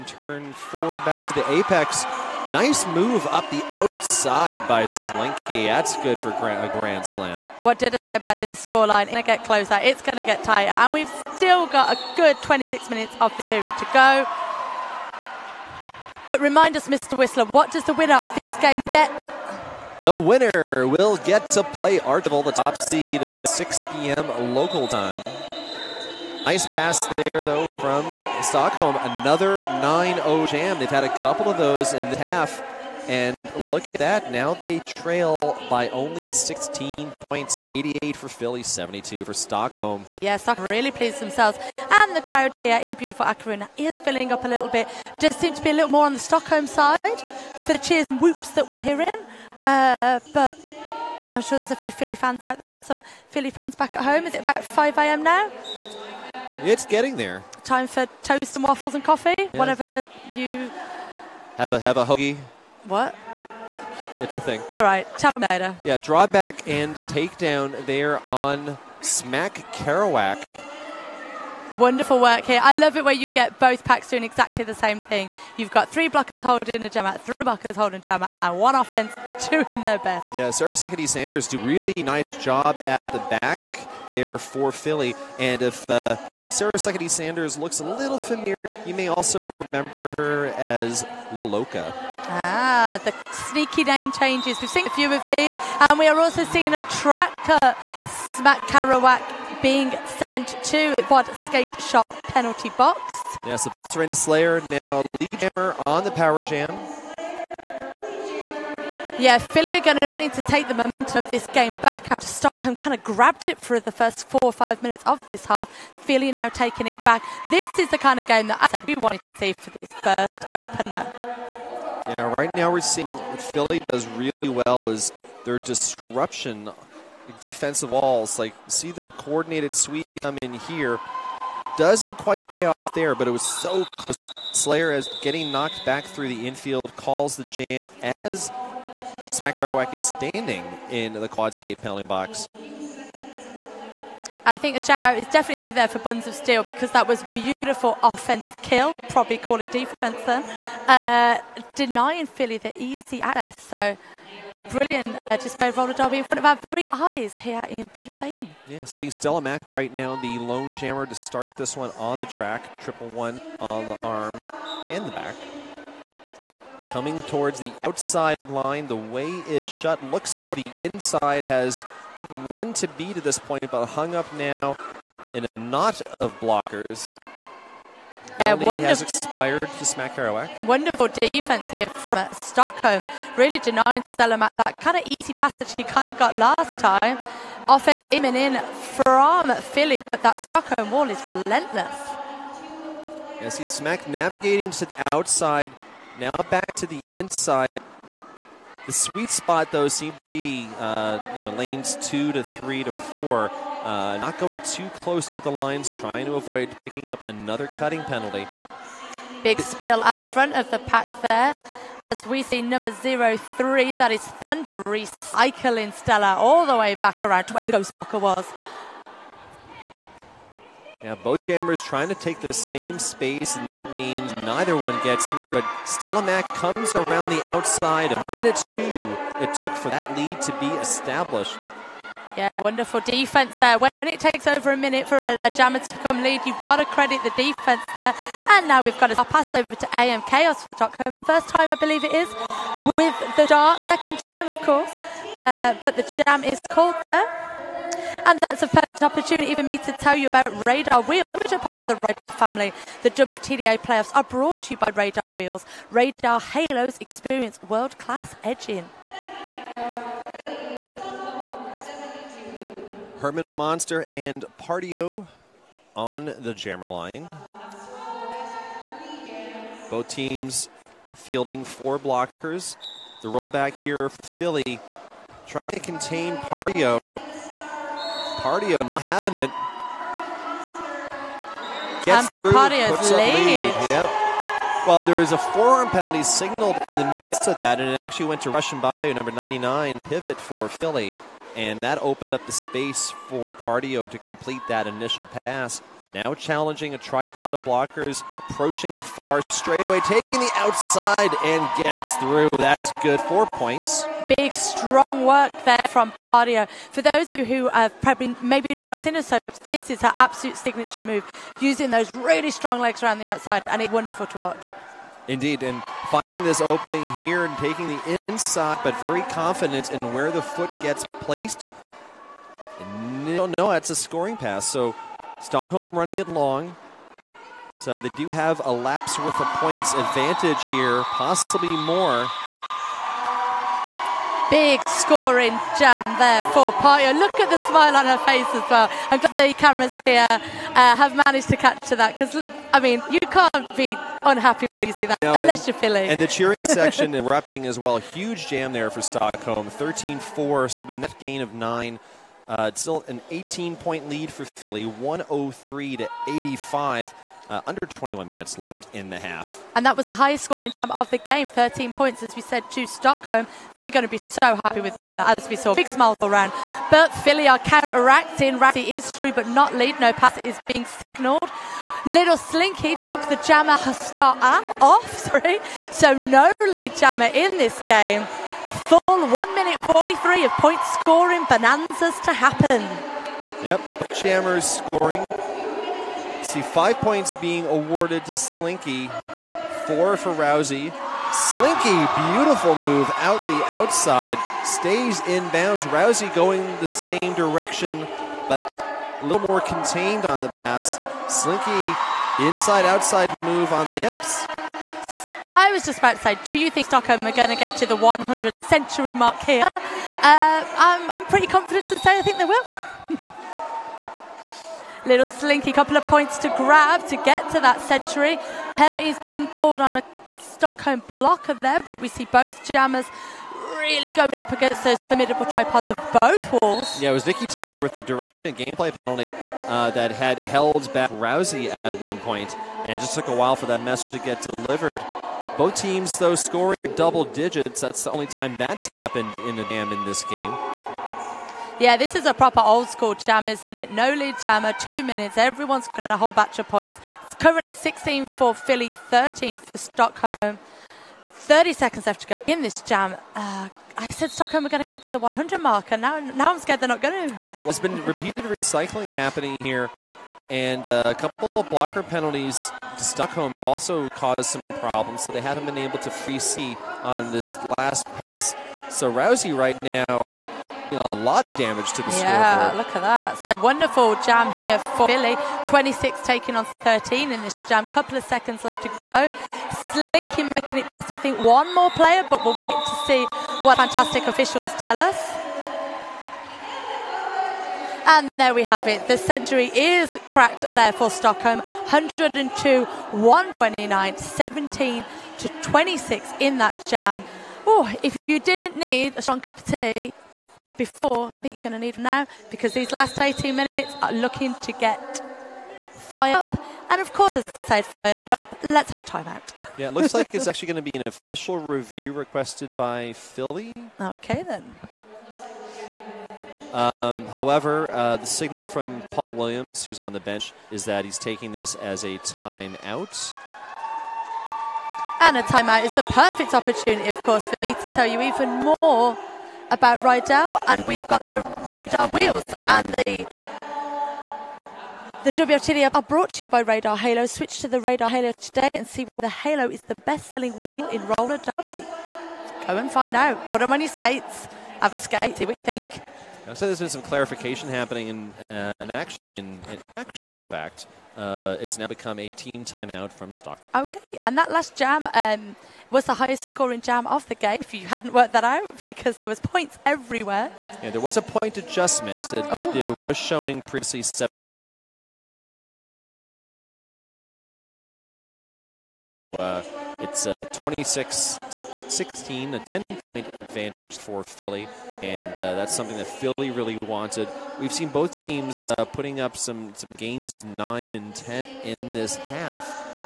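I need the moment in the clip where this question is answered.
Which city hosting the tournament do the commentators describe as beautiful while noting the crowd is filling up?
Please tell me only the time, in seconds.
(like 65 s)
43 s.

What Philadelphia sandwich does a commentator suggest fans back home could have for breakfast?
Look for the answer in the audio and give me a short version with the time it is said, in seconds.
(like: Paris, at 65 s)
A hoagie, at 62 s.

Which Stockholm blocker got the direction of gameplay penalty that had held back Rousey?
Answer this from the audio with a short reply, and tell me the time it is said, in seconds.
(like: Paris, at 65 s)
Vicky Tapper, at 427 s.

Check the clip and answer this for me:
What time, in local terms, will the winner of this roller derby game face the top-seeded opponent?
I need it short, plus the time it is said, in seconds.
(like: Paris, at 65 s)
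6 p.m., at 23 s.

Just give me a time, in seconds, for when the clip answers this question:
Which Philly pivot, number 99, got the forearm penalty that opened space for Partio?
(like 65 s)
288 s.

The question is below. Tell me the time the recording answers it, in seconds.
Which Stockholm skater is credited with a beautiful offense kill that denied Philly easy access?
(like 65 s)
145 s.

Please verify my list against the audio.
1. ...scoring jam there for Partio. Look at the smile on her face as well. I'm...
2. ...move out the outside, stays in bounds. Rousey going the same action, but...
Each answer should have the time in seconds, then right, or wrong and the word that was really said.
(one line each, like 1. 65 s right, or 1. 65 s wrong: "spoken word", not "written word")
1. 334 s right
2. 392 s wrong: "direction", not "action".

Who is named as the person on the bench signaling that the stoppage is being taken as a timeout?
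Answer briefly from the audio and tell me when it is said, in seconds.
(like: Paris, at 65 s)
Paul Williams, at 519 s.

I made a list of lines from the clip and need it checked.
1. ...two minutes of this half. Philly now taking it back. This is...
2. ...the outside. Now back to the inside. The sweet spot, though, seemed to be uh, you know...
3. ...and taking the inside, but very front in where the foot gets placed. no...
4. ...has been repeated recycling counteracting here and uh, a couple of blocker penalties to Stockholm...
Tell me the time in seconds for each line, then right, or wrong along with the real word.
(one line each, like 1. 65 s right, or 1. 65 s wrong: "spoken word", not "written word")
1. 114 s wrong: "five", not "two"
2. 194 s right
3. 317 s wrong: "confident", not "front"
4. 457 s wrong: "happening", not "counteracting".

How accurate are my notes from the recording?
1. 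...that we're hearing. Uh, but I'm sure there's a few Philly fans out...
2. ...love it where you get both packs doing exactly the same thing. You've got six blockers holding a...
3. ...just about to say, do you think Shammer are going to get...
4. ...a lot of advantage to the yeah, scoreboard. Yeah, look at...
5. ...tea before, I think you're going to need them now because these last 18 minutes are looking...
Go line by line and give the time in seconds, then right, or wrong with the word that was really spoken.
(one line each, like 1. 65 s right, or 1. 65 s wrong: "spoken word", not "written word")
1. 48 s right
2. 72 s wrong: "three", not "six"
3. 405 s wrong: "Stockholm", not "Shammer"
4. 471 s wrong: "damage", not "advantage"
5. 499 s right.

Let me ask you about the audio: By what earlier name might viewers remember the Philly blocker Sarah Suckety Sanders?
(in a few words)
Lil Loca.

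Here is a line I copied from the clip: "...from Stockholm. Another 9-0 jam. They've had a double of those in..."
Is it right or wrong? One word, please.
wrong.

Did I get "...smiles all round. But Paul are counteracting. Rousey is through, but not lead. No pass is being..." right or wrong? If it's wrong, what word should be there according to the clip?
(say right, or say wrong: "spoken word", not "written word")
wrong: "Philly", not "Paul".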